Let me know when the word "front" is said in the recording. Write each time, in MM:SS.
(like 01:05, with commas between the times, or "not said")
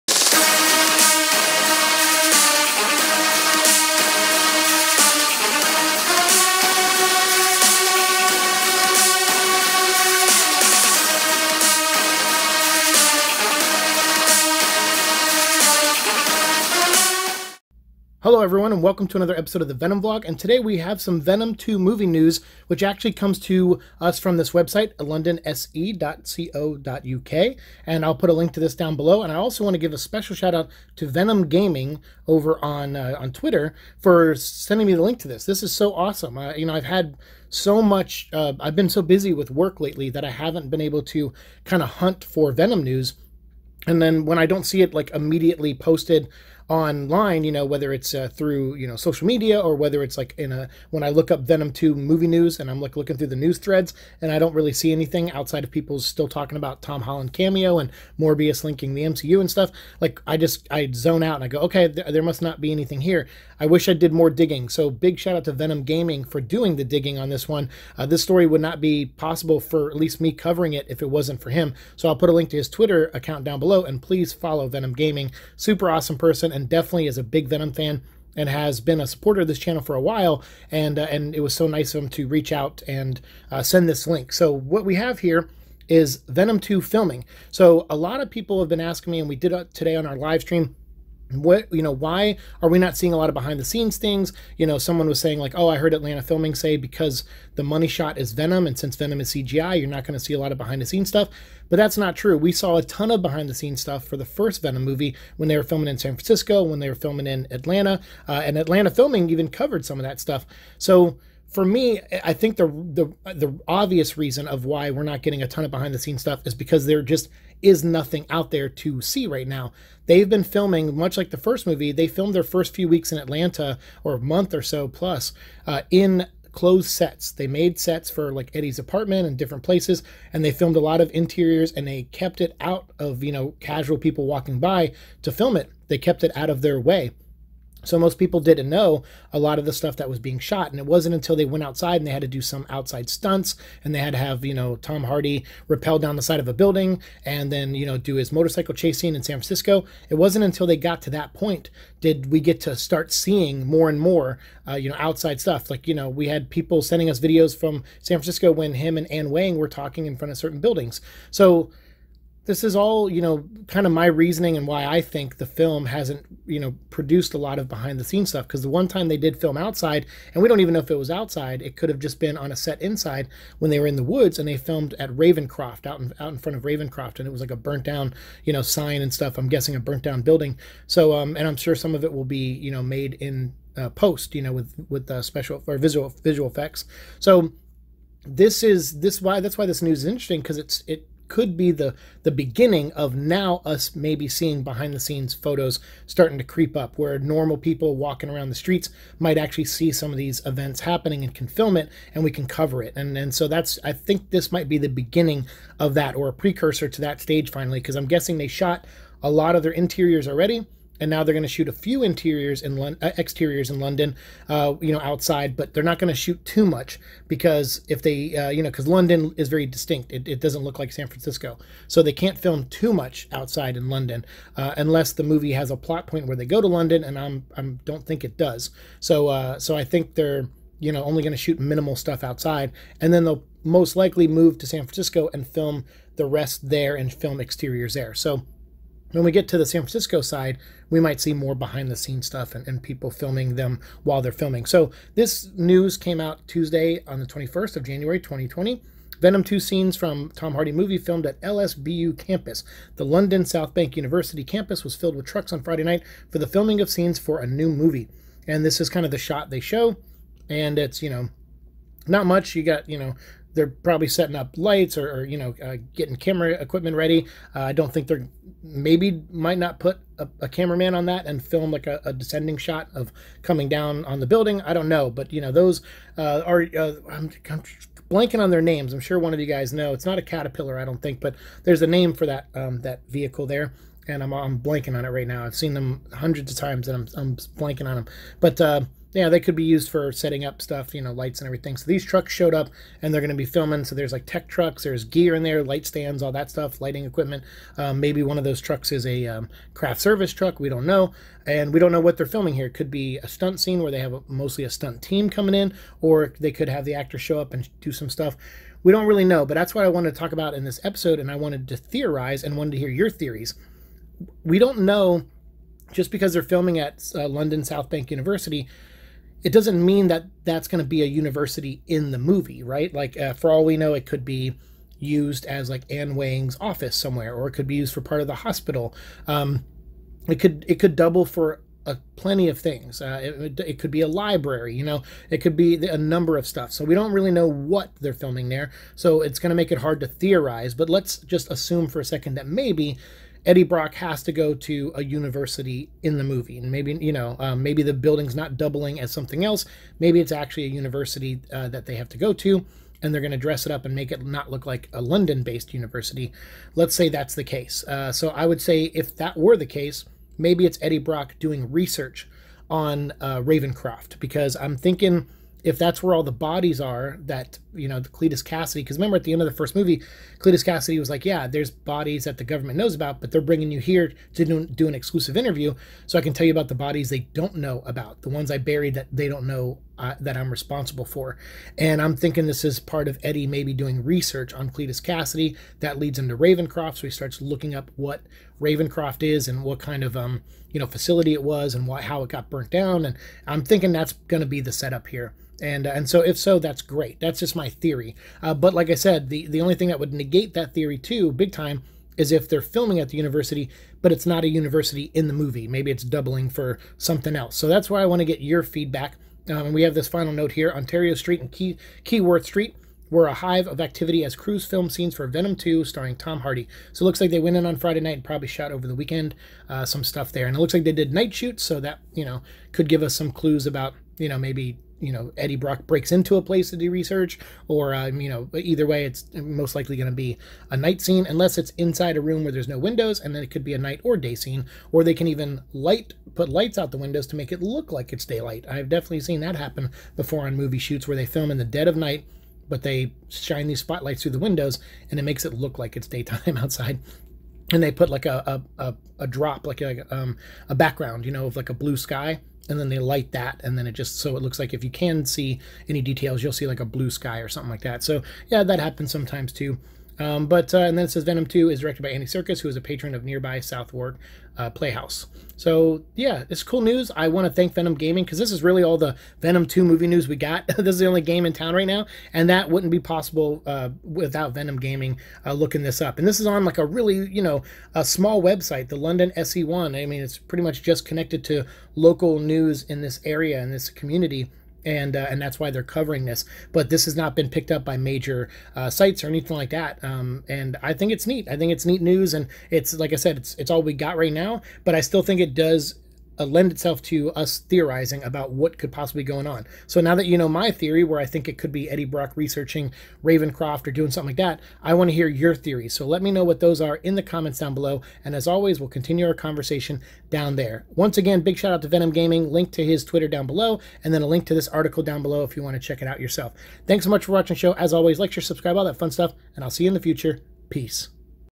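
02:40, 02:56.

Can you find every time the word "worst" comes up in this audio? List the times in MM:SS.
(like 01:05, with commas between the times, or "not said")
not said.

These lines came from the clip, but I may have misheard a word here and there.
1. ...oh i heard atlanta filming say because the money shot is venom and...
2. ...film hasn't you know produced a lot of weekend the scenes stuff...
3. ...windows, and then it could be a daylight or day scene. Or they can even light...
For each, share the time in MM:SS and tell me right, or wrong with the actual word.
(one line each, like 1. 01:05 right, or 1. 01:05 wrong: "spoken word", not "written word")
1. 01:35 right
2. 02:45 wrong: "behind", not "weekend"
3. 07:12 wrong: "night", not "daylight".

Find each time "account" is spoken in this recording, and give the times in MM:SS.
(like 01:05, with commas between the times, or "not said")
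01:13.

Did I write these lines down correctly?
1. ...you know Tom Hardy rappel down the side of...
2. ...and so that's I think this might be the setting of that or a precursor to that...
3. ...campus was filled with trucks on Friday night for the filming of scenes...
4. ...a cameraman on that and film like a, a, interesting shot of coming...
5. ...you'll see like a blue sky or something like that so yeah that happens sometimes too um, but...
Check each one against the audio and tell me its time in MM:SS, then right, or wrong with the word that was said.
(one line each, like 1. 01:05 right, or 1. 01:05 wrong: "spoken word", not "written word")
1. 02:24 right
2. 03:23 wrong: "beginning", not "setting"
3. 04:14 right
4. 04:30 wrong: "descending", not "interesting"
5. 07:36 right.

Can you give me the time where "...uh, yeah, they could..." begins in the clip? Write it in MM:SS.
04:48.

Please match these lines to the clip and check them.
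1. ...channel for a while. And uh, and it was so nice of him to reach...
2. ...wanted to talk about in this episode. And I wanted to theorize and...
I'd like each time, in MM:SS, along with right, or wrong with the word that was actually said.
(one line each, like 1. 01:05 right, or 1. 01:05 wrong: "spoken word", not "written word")
1. 01:19 right
2. 05:09 right.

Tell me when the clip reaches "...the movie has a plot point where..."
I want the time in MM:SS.
03:45.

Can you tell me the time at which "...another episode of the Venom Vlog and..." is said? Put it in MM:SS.
00:19.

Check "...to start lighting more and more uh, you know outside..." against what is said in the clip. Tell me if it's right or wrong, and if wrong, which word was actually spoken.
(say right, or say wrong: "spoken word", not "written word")
wrong: "seeing", not "lighting".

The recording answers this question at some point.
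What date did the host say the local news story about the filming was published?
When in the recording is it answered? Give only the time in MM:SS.
04:07.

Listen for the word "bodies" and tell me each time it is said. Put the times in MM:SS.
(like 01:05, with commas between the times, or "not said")
06:06, 06:11, 06:16.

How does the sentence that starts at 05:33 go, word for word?
Uh, it, it, could be a library, you know, it could be a number of stuff.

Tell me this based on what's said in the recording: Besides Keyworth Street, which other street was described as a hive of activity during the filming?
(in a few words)
Ontario Street.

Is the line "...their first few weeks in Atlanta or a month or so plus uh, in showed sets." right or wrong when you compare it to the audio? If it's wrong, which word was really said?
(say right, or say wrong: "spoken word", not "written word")
wrong: "closed", not "showed".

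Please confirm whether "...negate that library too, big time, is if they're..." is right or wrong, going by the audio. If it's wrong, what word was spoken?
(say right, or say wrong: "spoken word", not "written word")
wrong: "theory", not "library".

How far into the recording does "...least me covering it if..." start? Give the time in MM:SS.
01:09.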